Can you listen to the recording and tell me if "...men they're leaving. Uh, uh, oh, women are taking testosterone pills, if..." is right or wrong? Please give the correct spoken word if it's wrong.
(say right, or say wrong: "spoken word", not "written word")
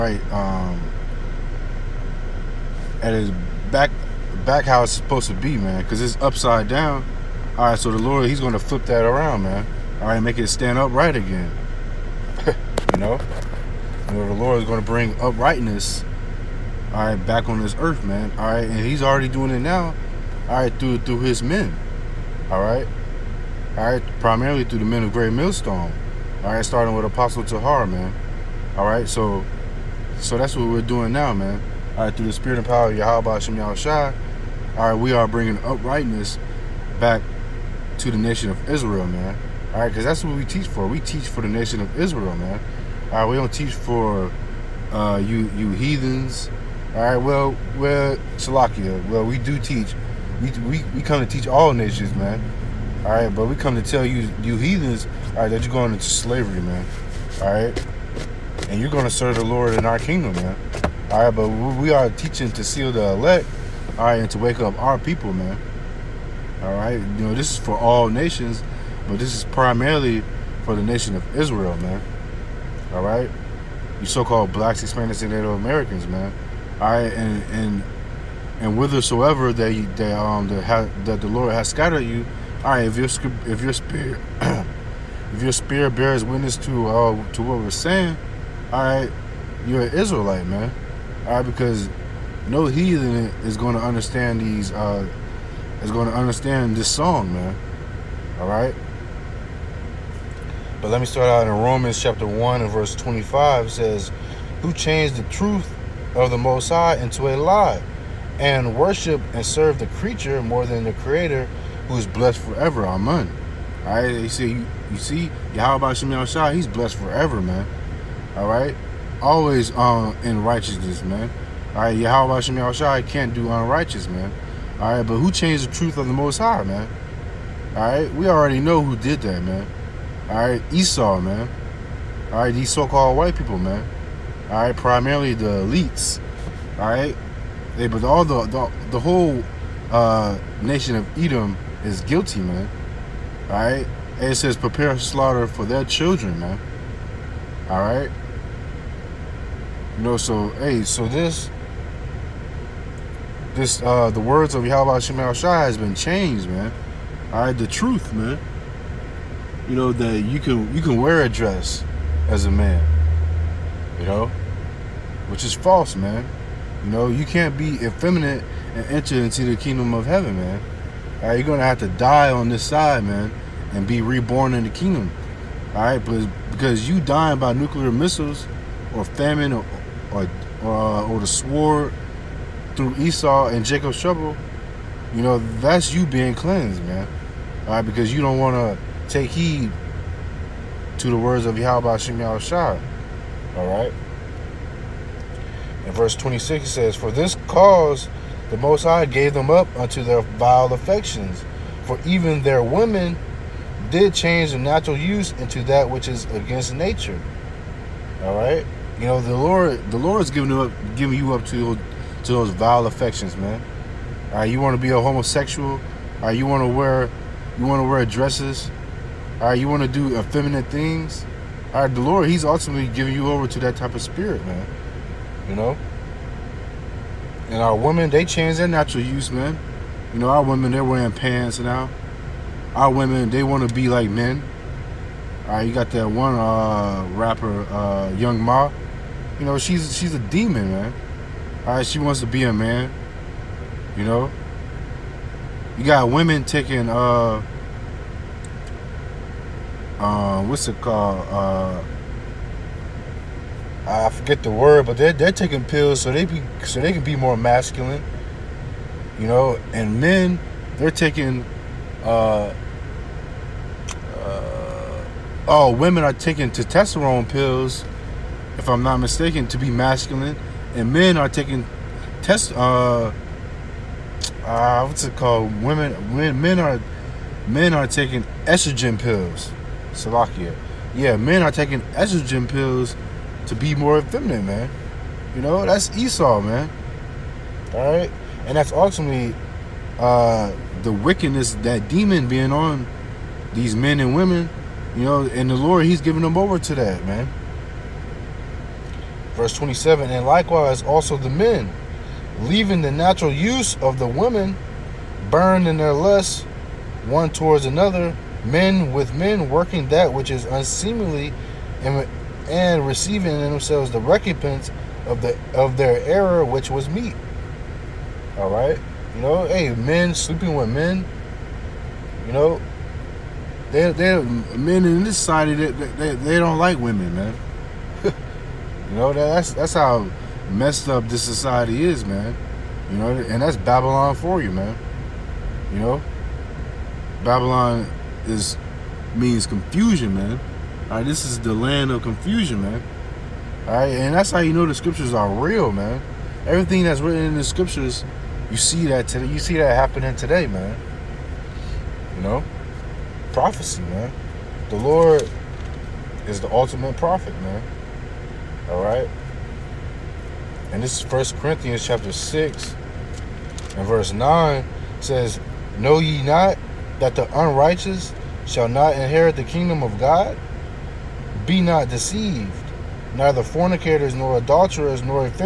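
wrong: "taking", not "leaving".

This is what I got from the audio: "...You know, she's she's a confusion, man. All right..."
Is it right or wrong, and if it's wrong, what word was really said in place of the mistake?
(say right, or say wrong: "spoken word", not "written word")
wrong: "demon", not "confusion".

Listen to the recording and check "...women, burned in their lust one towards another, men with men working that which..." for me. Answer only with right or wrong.
right.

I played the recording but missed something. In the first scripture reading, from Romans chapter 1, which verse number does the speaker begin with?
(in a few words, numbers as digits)
25.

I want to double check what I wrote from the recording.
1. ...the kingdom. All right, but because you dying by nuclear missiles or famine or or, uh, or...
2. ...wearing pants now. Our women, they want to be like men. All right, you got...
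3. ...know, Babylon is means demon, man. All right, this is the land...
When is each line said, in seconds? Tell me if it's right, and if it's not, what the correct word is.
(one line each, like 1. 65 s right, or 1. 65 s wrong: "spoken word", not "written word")
1. 174 s right
2. 230 s right
3. 335 s wrong: "confusion", not "demon".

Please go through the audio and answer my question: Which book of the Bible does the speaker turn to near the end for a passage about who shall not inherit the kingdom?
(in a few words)
First Corinthians.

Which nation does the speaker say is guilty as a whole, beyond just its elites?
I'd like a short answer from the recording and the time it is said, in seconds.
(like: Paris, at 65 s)
Edom, at 141 s.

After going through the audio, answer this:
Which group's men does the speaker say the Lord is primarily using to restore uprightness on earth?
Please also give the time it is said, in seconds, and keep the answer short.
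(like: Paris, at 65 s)
Great Millstone, at 25 s.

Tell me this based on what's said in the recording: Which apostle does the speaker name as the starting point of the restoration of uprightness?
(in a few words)
Apostle Tahar.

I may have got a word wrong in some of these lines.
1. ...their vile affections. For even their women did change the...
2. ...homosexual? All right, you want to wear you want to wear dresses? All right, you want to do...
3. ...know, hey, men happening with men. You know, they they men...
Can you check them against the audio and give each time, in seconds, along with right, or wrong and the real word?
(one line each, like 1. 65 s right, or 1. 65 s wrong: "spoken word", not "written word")
1. 200 s right
2. 215 s right
3. 319 s wrong: "sleeping", not "happening".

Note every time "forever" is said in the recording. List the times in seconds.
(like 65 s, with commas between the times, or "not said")
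112 s, 116 s.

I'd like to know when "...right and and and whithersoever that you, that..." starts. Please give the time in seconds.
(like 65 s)
76 s.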